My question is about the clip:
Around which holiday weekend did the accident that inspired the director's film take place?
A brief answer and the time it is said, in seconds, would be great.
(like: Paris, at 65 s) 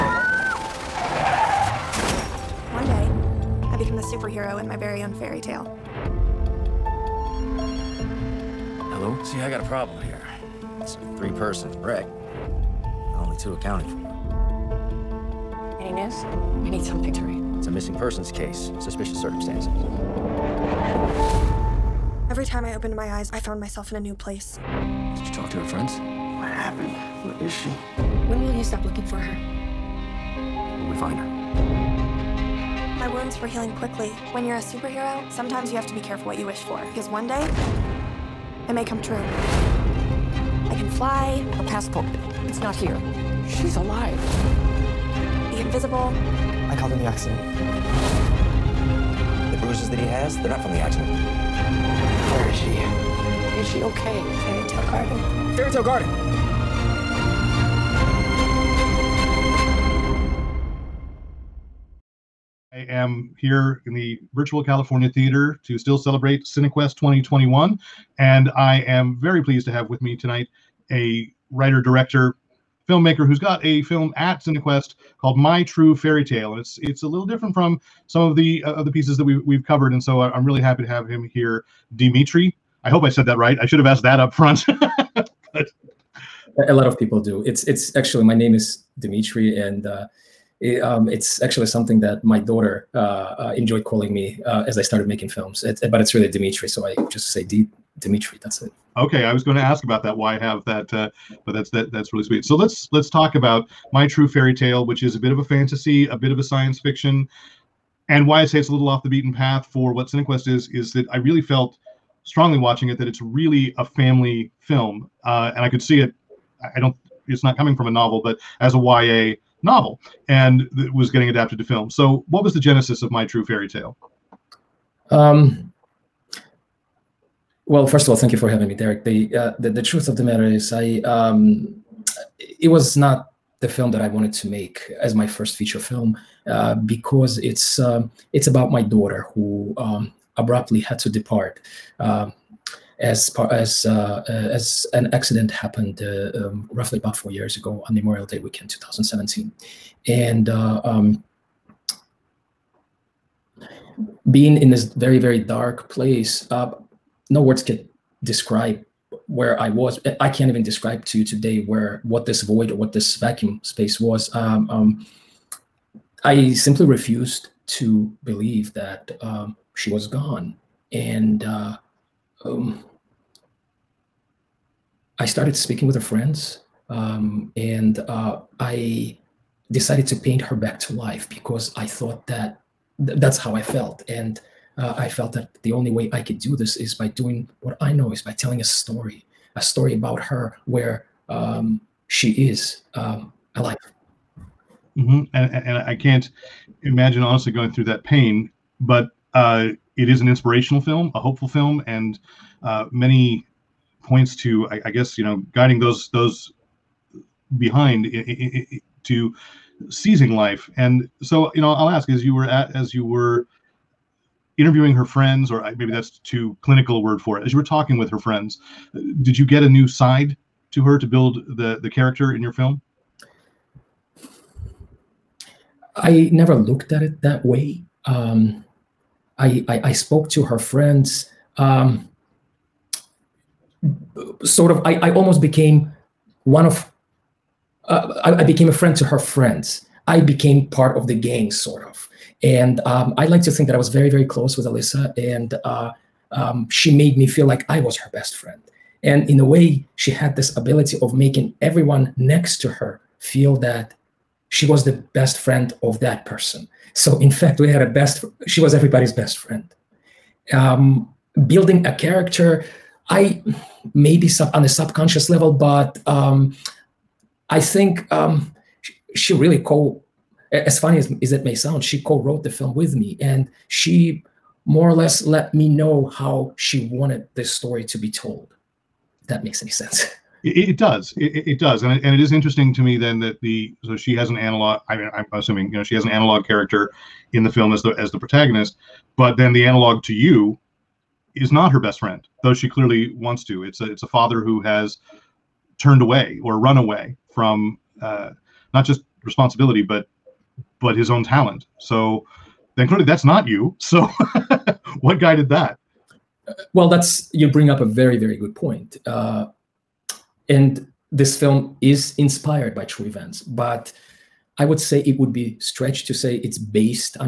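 Memorial Day weekend, at 147 s.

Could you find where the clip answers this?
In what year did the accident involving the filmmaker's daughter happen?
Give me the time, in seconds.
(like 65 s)
148 s.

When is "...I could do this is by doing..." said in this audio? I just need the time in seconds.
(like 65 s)
186 s.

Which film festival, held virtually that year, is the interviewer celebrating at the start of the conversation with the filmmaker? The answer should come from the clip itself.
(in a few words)
Cinequest 2021.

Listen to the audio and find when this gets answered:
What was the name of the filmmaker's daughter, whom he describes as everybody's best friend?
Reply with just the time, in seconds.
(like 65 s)
244 s.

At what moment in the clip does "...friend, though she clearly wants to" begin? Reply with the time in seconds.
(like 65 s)
291 s.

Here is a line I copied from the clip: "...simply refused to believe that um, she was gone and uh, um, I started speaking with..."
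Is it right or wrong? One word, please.
right.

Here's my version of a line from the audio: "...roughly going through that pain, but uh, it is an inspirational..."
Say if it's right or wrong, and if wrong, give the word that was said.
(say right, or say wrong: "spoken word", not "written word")
wrong: "honestly", not "roughly".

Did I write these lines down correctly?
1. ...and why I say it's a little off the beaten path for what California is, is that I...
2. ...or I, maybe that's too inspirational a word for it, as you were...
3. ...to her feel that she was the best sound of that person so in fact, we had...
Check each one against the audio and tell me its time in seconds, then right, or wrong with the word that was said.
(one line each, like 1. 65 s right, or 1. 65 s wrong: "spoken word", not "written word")
1. 108 s wrong: "Cinequest", not "California"
2. 215 s wrong: "clinical", not "inspirational"
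3. 252 s wrong: "friend", not "sound".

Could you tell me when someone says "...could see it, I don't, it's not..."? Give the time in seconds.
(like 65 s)
115 s.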